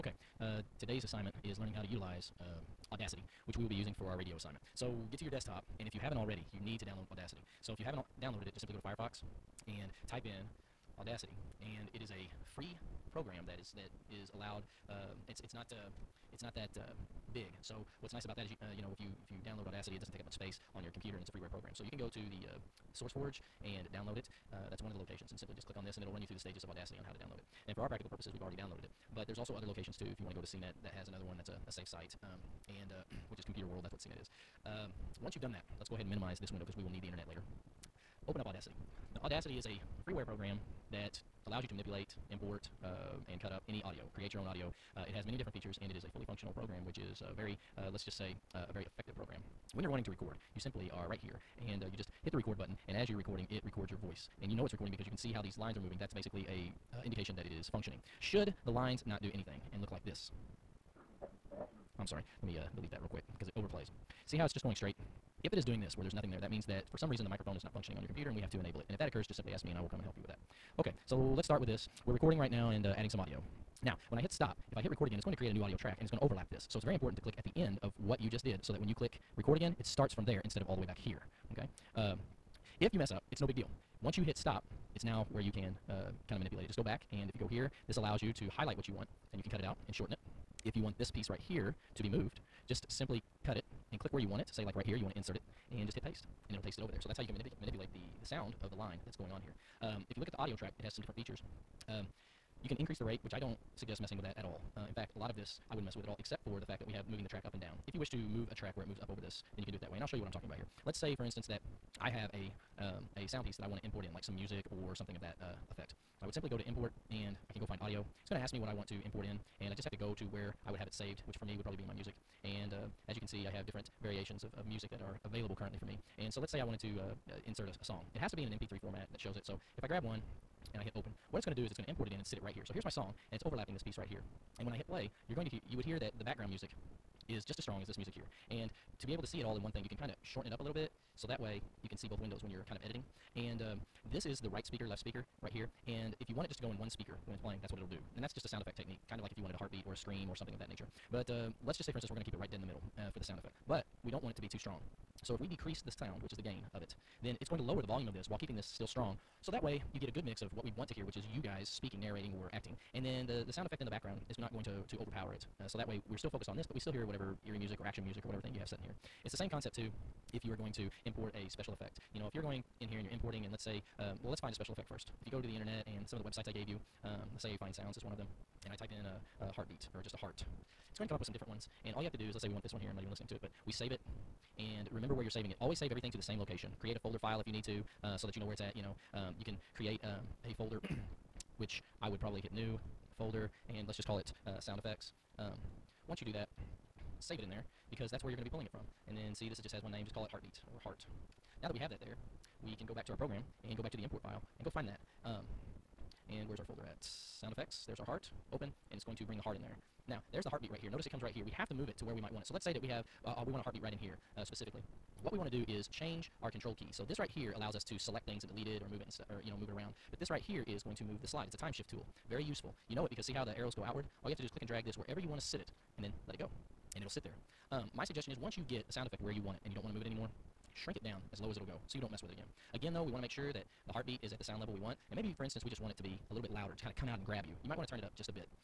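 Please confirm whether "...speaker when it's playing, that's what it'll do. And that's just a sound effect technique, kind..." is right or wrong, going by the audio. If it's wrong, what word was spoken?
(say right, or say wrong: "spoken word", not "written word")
right.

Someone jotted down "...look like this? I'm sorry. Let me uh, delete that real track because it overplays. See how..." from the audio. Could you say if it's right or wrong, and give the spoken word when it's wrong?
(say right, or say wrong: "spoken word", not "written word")
wrong: "quick", not "track".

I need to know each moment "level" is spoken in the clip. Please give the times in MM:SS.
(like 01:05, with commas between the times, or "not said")
03:54.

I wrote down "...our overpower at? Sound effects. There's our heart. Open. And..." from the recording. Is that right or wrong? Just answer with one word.
wrong.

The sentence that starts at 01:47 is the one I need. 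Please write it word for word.
If you wish to move a track where it moves up over this, then you can do it that way.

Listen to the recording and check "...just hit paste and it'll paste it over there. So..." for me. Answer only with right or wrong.
right.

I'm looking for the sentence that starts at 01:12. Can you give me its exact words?
We're recording right now and uh, adding some audio.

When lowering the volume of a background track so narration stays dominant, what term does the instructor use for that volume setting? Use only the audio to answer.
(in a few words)
gain.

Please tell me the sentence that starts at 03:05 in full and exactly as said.
Always save everything to the same location.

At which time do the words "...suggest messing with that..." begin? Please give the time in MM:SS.
01:43.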